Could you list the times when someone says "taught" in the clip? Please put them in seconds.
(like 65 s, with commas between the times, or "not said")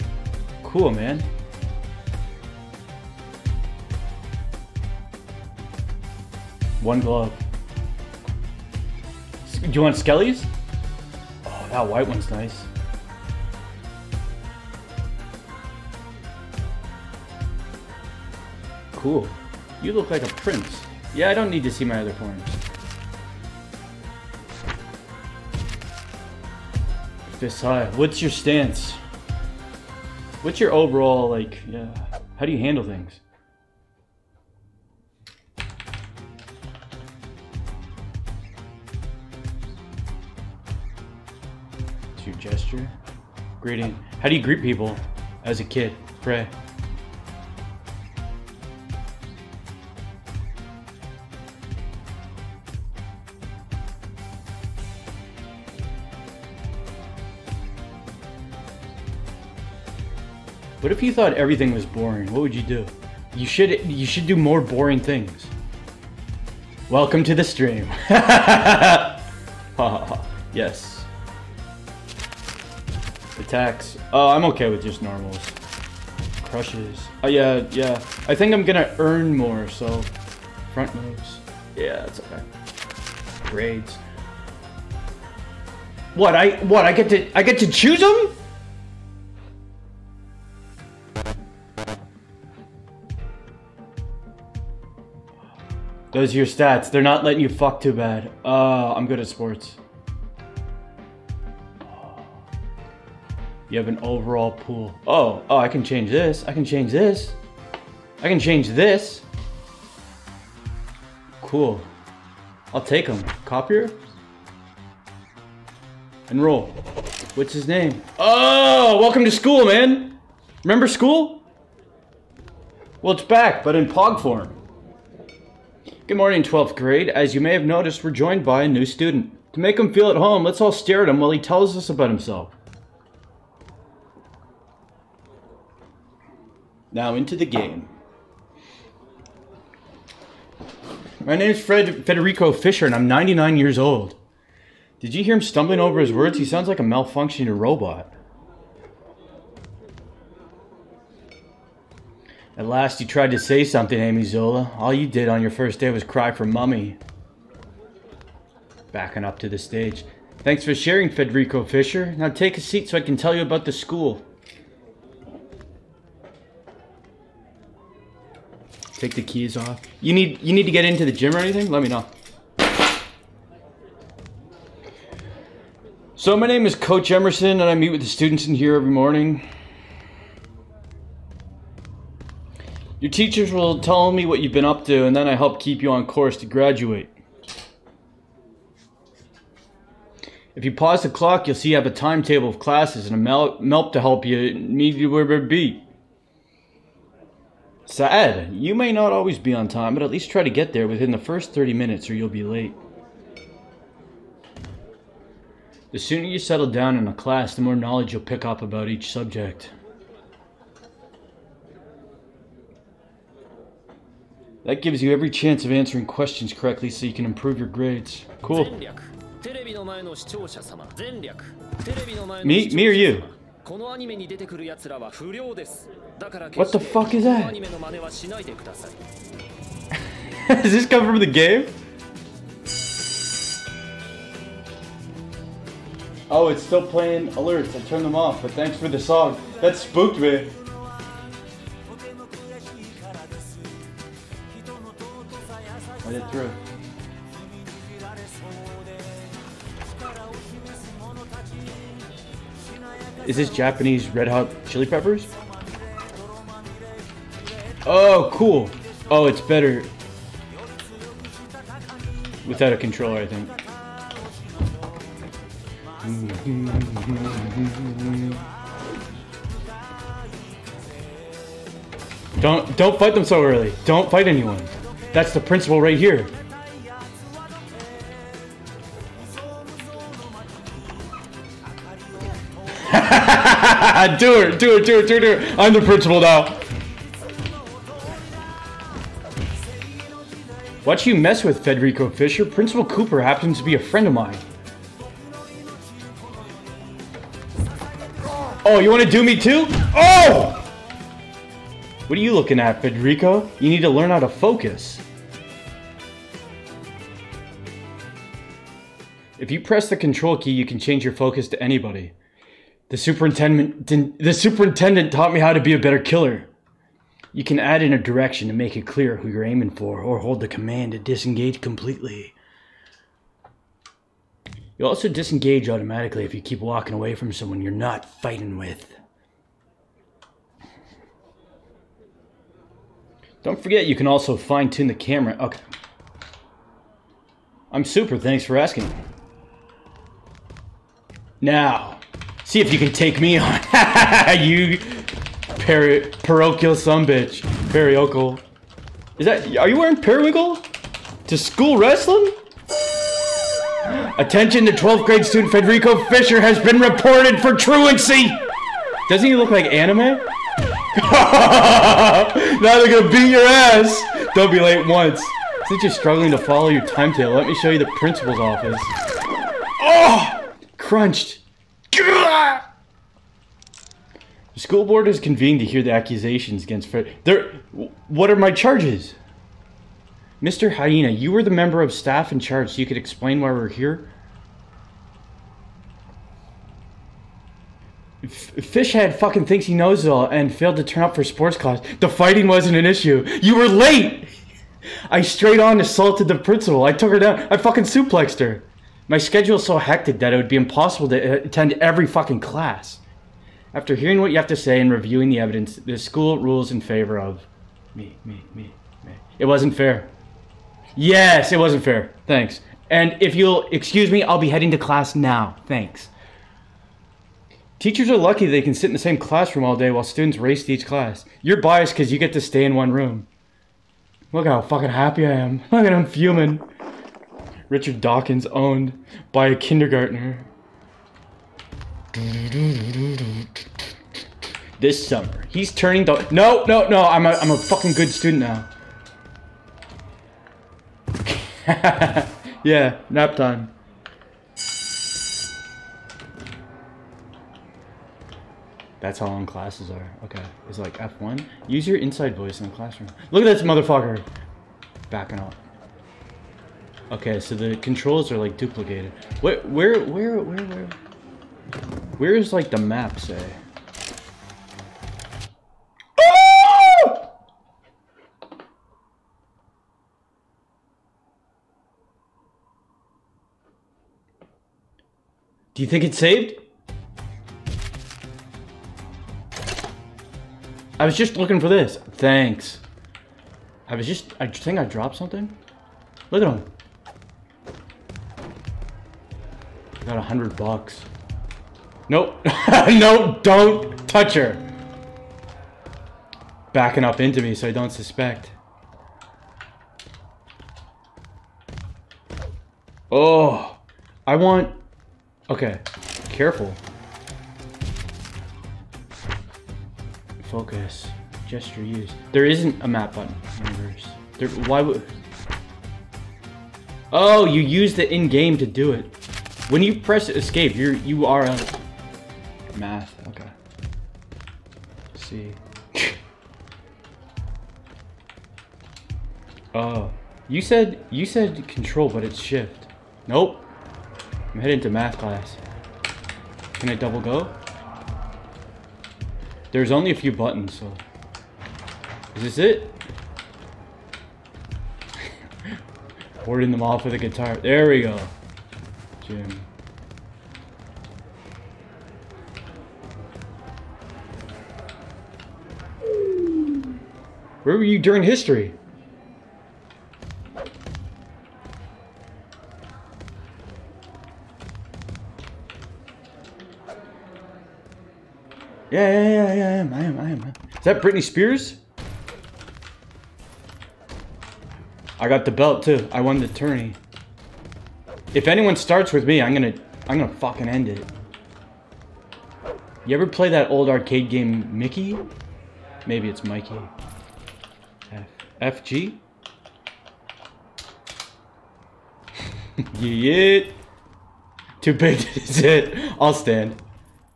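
315 s.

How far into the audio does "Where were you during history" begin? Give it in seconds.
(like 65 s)
557 s.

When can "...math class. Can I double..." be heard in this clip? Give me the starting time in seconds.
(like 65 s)
534 s.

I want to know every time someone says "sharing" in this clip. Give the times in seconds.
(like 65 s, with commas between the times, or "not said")
160 s.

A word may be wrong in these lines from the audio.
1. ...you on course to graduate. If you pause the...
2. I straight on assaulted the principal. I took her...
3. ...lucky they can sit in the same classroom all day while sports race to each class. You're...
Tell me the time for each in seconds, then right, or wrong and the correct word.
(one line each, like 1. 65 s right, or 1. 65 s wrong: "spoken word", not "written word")
1. 185 s right
2. 395 s right
3. 418 s wrong: "students", not "sports".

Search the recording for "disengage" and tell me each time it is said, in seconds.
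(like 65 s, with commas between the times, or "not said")
320 s, 325 s.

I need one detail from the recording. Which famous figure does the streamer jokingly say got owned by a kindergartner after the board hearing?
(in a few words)
Richard Dawkins.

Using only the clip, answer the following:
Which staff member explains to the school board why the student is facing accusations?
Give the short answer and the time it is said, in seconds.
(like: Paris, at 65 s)
Mr. Hyena, at 380 s.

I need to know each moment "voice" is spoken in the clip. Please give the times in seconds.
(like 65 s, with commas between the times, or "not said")
452 s.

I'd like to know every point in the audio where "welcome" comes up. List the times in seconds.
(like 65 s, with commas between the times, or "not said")
66 s, 118 s.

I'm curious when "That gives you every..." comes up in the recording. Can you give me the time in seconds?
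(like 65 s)
214 s.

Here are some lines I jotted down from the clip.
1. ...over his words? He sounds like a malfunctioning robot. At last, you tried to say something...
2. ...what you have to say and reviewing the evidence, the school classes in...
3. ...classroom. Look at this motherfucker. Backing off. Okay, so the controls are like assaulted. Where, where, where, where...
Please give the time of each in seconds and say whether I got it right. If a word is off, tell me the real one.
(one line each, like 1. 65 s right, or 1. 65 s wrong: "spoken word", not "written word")
1. 145 s right
2. 404 s wrong: "rules", not "classes"
3. 452 s wrong: "duplicated", not "assaulted".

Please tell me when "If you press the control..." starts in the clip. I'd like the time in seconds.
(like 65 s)
309 s.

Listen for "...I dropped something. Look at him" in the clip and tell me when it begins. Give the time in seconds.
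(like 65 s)
484 s.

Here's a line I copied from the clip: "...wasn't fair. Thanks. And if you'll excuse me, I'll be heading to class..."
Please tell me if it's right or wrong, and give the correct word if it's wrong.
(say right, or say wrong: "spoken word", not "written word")
right.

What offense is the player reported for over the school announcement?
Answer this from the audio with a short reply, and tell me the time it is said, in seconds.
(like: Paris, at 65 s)
truancy, at 357 s.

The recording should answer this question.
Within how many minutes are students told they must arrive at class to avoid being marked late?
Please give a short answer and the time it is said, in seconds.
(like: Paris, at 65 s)
30, at 201 s.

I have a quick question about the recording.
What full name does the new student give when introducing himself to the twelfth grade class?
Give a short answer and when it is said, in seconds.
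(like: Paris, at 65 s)
Fred Federico Fisher, at 141 s.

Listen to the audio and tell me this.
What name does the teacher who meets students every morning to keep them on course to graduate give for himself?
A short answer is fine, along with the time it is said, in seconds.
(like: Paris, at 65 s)
Coach Emerson, at 176 s.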